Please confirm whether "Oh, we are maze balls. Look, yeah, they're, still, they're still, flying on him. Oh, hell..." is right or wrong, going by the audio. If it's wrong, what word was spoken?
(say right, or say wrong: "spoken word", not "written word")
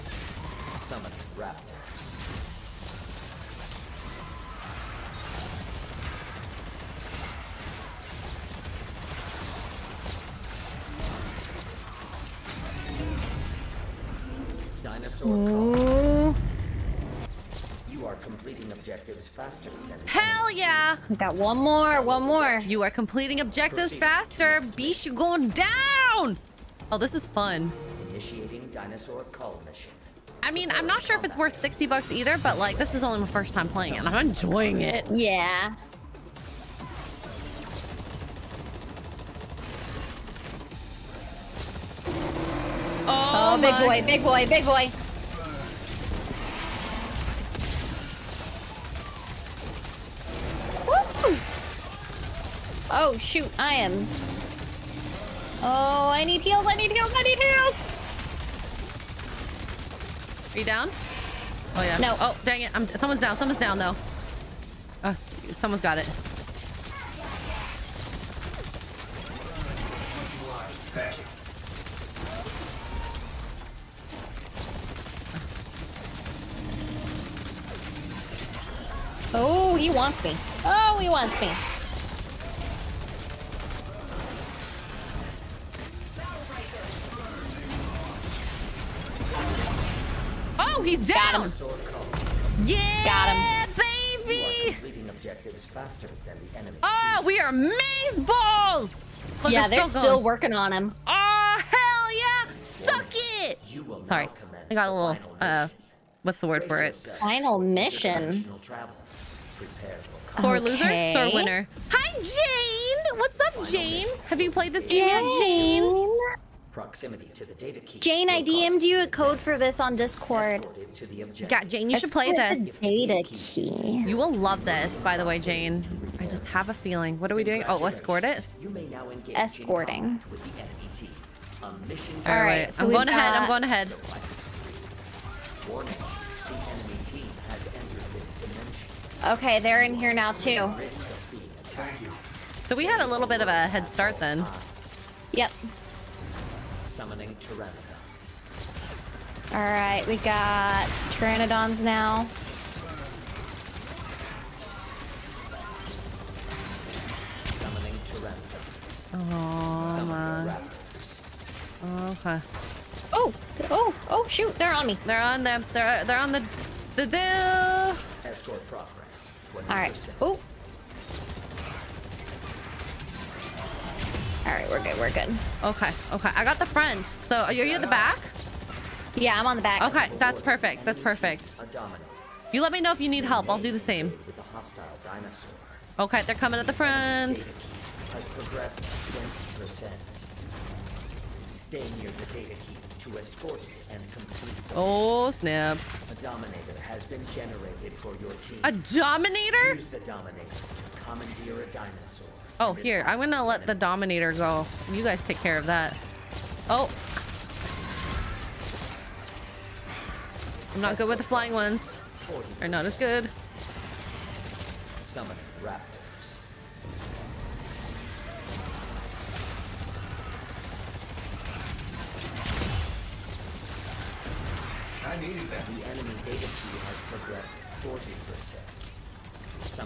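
wrong: "working", not "flying".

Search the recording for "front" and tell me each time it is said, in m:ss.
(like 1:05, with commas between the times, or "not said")
2:56, 3:06.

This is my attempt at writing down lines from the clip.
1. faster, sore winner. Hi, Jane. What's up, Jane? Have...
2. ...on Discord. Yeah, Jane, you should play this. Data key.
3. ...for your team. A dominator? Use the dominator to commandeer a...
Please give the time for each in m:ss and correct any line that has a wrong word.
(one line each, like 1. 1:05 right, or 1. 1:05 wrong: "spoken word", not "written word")
1. 1:50 wrong: "loser", not "faster"
2. 1:59 right
3. 3:17 right.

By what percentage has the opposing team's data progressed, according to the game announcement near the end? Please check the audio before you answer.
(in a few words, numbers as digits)
40%.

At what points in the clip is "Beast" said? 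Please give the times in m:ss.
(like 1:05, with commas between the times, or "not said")
0:24.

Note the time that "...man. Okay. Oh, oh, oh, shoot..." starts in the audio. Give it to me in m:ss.
2:40.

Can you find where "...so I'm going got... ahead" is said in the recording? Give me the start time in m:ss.
2:12.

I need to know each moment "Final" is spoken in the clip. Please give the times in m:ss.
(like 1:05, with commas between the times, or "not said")
1:46.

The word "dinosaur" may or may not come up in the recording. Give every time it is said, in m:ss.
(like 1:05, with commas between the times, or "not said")
0:14, 0:28, 3:21.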